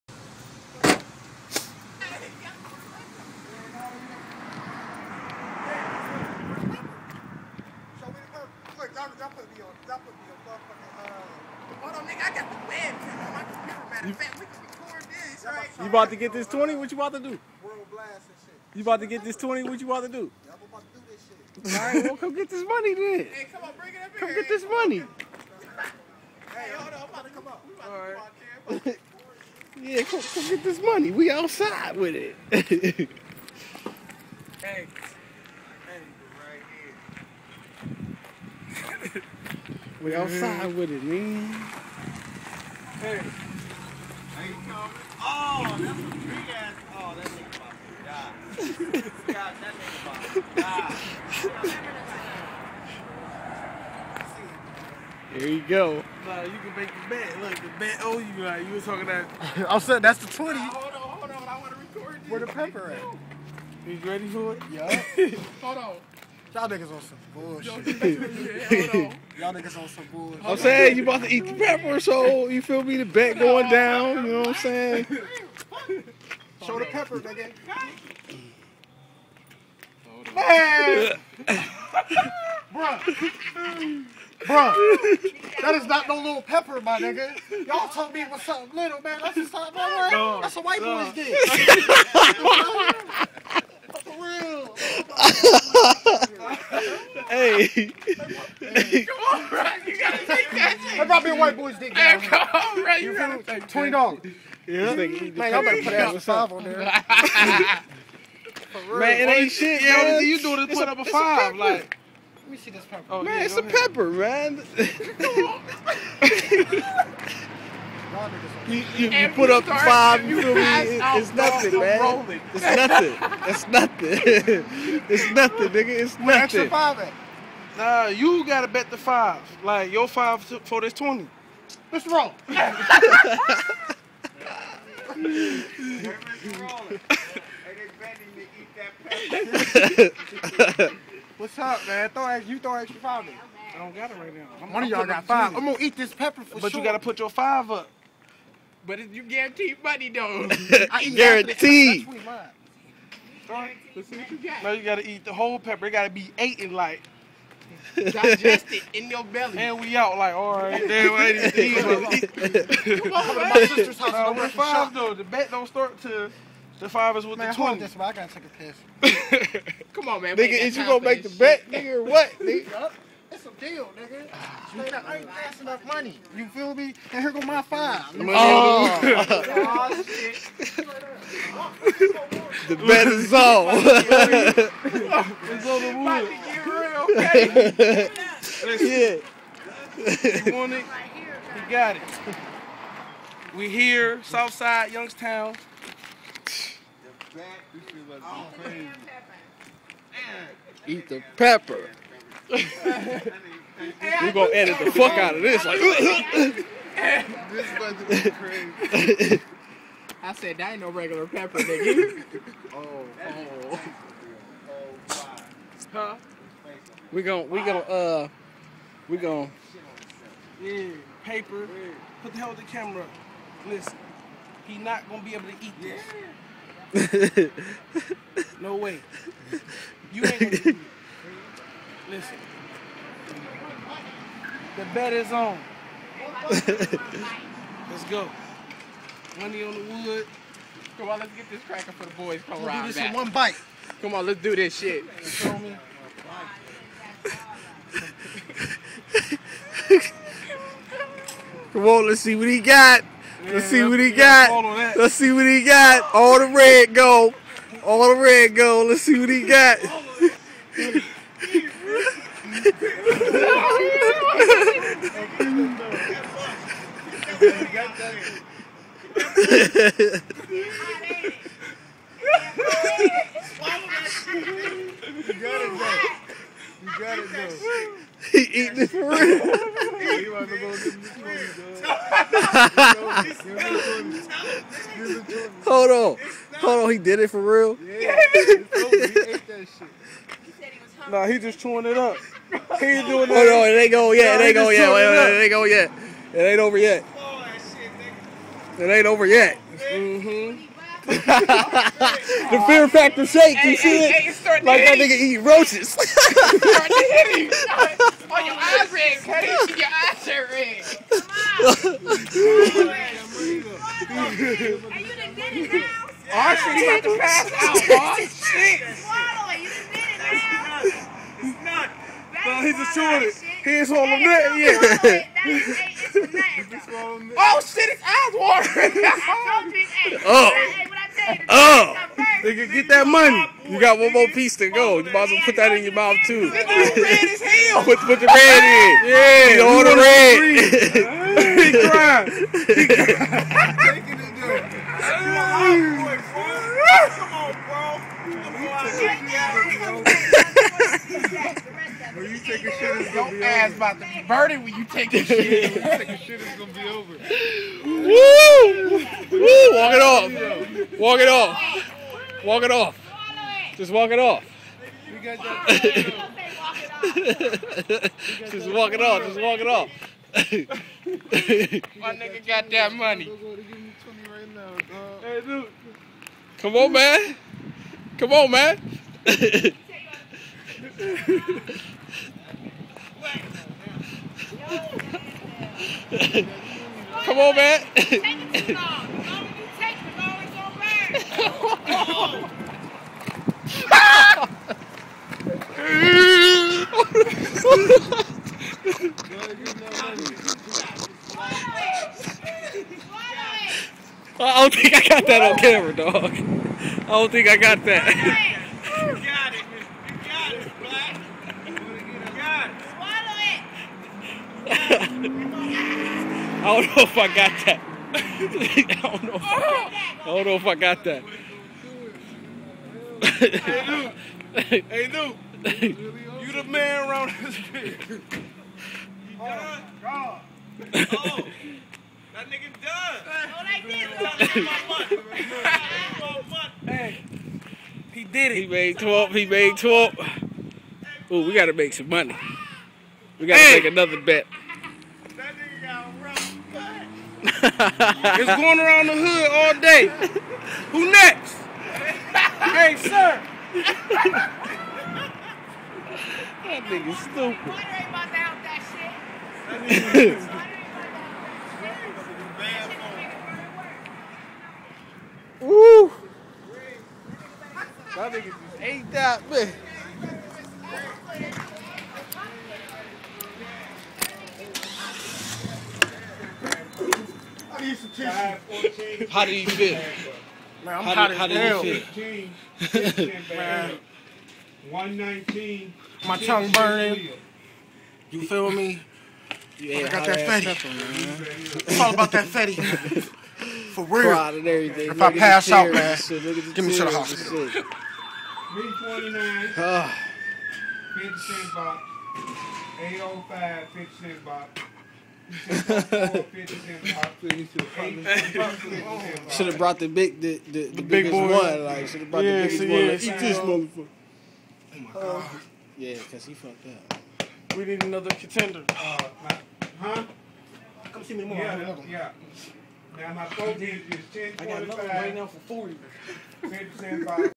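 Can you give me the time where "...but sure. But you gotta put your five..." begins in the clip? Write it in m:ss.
2:26.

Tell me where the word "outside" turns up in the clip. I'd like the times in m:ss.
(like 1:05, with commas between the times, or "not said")
0:31, 0:40.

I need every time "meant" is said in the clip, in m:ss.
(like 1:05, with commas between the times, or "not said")
not said.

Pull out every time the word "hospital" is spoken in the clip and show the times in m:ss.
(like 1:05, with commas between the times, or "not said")
8:17.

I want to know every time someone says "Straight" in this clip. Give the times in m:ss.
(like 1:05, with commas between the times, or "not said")
2:54.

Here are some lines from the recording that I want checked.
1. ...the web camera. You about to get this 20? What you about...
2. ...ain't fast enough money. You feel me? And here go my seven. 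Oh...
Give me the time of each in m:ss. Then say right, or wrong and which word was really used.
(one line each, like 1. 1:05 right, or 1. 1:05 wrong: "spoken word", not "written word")
1. 0:12 right
2. 2:55 wrong: "five", not "seven".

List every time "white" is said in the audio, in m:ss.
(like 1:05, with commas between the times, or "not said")
1:30, 1:41.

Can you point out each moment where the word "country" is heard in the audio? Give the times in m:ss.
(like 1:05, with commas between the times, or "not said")
not said.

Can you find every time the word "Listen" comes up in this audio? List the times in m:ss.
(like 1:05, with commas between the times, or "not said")
3:43.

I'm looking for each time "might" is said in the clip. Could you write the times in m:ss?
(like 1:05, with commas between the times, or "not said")
1:41, 5:35.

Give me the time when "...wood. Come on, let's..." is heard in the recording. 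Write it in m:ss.
4:00.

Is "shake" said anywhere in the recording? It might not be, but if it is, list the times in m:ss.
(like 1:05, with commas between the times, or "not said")
5:03.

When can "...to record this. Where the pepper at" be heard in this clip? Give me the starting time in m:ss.
1:01.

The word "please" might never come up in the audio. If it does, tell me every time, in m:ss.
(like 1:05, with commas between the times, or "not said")
not said.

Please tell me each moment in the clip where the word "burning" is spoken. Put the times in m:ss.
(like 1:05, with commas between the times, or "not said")
5:54, 8:06.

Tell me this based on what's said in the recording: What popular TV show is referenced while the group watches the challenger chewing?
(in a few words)
Fear Factor.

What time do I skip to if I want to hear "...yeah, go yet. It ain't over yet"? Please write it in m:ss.
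4:54.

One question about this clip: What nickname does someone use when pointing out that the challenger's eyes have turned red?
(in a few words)
Cuddy.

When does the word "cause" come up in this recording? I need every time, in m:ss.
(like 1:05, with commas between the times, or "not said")
8:36.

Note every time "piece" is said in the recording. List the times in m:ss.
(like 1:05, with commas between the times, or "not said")
5:34.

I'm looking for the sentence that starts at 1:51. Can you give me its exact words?
Like, let me see this pepper.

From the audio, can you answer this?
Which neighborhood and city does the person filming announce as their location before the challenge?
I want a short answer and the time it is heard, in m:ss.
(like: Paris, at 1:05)
Southside, Youngstown, at 3:14.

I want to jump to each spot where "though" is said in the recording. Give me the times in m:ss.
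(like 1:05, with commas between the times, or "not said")
2:30, 2:45.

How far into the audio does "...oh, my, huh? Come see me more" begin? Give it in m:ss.
8:38.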